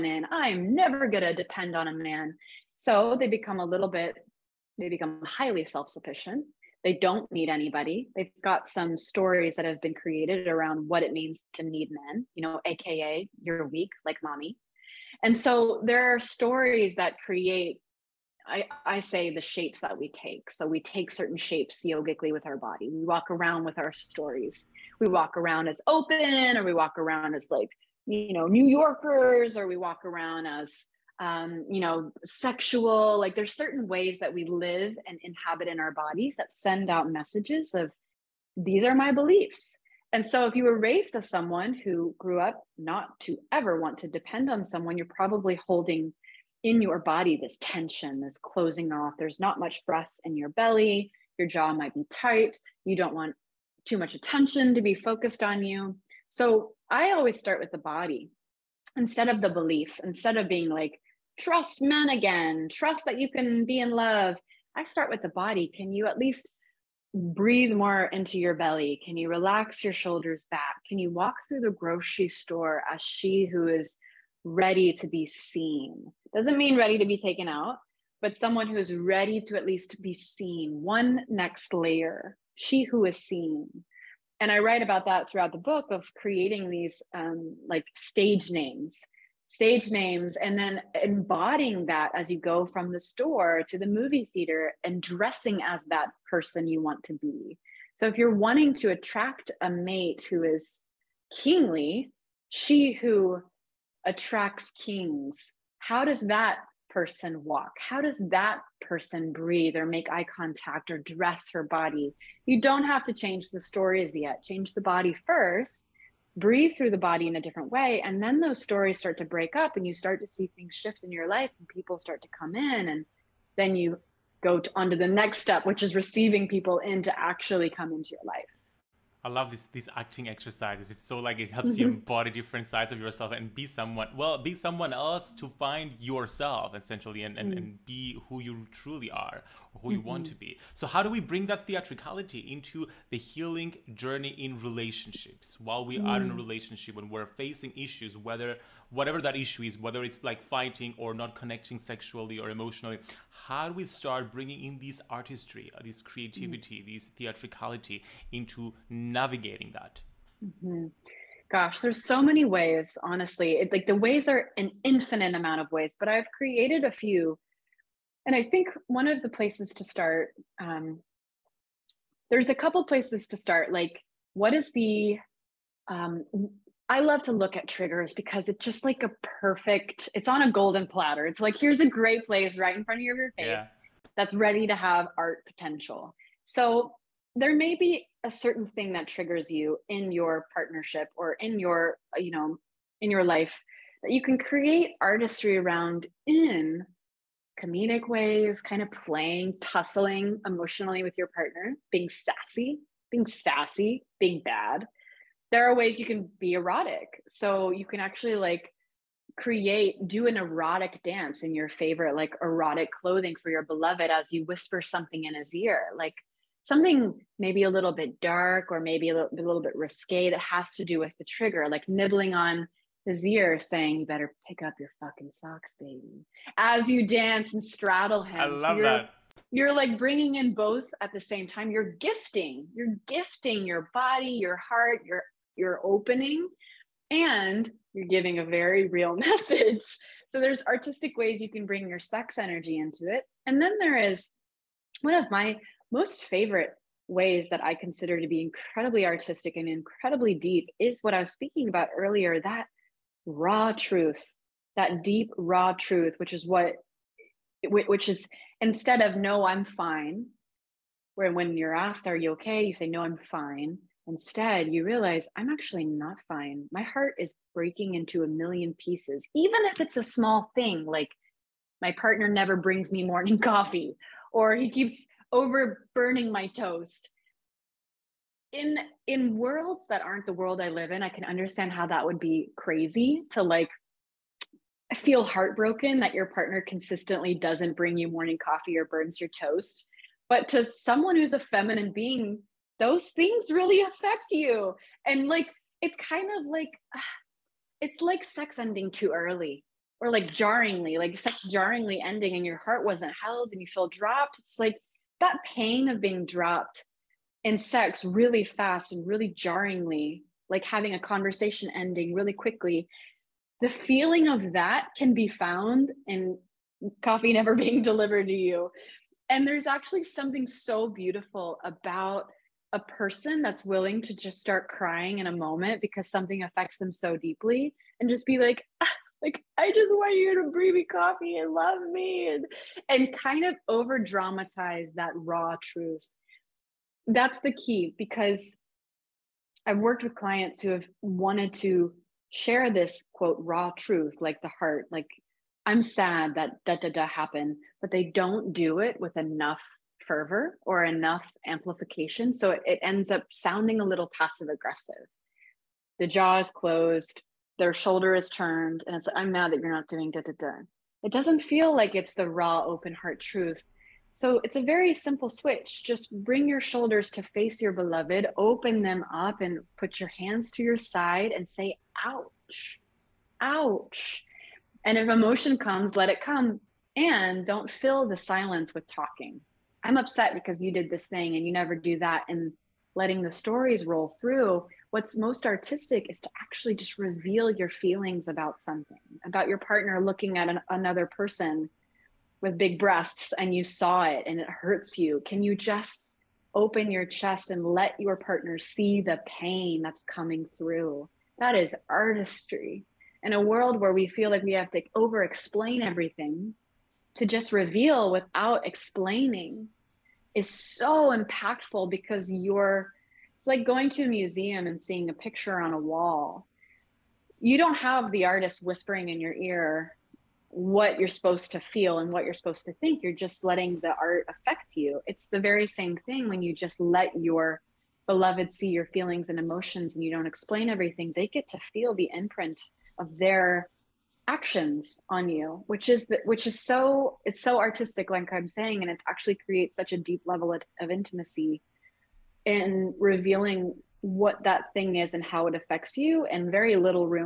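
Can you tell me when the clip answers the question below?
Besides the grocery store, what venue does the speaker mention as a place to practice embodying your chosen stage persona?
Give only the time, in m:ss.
1:33.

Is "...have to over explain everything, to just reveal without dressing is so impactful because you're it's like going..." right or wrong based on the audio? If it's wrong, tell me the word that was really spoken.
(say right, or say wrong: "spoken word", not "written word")
wrong: "explaining", not "dressing".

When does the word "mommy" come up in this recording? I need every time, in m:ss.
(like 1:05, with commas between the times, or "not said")
0:14.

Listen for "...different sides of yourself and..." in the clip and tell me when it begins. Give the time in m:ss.
2:12.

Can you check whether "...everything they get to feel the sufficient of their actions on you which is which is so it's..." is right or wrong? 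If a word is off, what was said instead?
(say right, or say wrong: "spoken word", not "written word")
wrong: "imprint", not "sufficient".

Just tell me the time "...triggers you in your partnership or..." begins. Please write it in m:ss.
3:09.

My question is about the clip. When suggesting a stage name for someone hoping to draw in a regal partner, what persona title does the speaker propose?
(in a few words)
She who attracts kings.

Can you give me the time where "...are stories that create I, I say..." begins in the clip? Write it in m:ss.
0:16.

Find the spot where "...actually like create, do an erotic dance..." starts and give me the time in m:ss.
3:27.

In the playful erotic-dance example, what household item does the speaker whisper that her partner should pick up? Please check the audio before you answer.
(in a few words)
socks.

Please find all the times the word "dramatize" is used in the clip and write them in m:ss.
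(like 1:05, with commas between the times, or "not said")
5:33.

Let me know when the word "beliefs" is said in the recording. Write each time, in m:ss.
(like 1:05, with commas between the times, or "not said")
0:39, 0:59.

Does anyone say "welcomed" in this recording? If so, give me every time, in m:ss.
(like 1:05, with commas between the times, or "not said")
not said.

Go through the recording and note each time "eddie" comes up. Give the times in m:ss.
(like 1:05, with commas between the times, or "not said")
not said.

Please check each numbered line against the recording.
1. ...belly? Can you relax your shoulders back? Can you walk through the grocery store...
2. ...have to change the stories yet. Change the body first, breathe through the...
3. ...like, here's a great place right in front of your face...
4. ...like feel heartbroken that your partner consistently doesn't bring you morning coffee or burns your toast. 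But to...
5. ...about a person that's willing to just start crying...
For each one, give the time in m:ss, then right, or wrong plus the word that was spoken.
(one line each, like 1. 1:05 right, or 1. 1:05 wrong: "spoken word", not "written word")
1. 1:08 right
2. 1:52 right
3. 3:01 right
4. 4:43 right
5. 5:21 right.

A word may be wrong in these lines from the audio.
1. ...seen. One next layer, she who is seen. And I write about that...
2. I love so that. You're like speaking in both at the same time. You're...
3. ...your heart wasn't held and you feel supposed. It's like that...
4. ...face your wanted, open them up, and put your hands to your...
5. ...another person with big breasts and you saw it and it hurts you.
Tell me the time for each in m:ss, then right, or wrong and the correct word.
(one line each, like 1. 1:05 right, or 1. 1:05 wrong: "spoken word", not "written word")
1. 1:20 right
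2. 3:48 wrong: "bringing", not "speaking"
3. 5:02 wrong: "dropped", not "supposed"
4. 6:07 wrong: "beloved", not "wanted"
5. 6:30 right.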